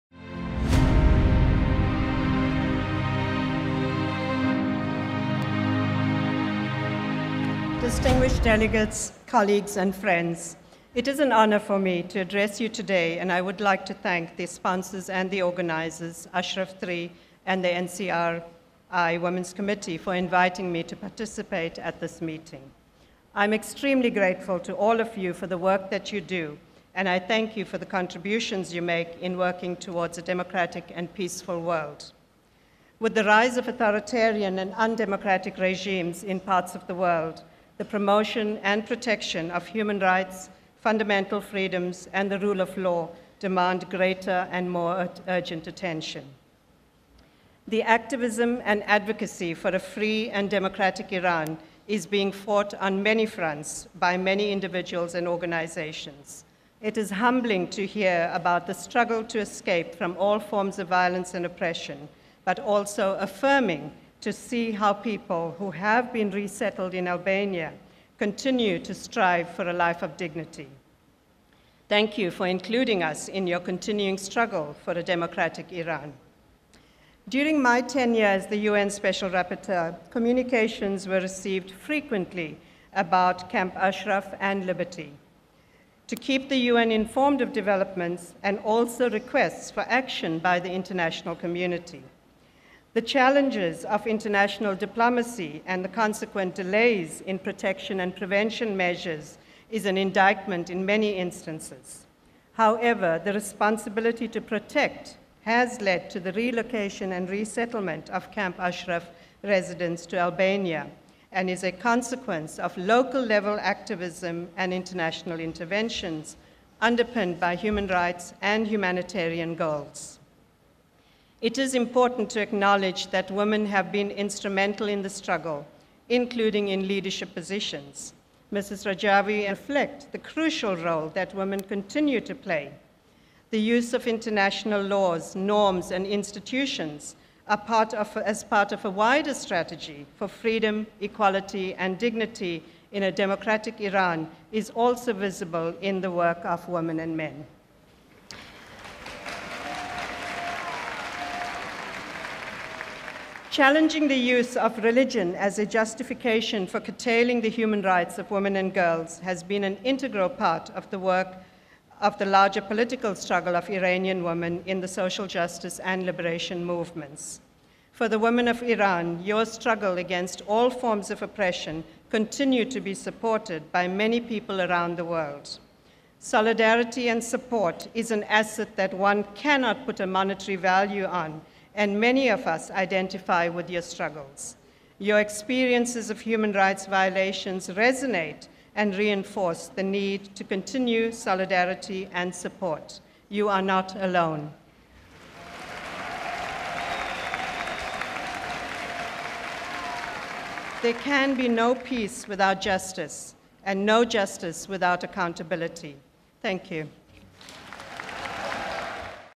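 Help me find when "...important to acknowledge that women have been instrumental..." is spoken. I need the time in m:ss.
2:01.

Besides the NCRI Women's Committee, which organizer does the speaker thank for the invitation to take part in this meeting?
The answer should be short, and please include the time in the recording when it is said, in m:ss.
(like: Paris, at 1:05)
Ashraf 3, at 0:16.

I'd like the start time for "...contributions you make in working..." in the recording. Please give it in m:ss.
0:27.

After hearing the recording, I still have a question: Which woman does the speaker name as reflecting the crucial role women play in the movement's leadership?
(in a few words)
Mrs. Rajavi.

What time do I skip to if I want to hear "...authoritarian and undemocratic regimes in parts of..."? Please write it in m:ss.
0:33.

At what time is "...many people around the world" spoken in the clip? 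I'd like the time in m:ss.
2:53.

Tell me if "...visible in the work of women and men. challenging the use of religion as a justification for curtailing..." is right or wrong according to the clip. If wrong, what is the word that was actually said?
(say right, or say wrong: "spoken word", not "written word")
right.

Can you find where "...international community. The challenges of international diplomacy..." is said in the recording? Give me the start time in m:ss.
1:30.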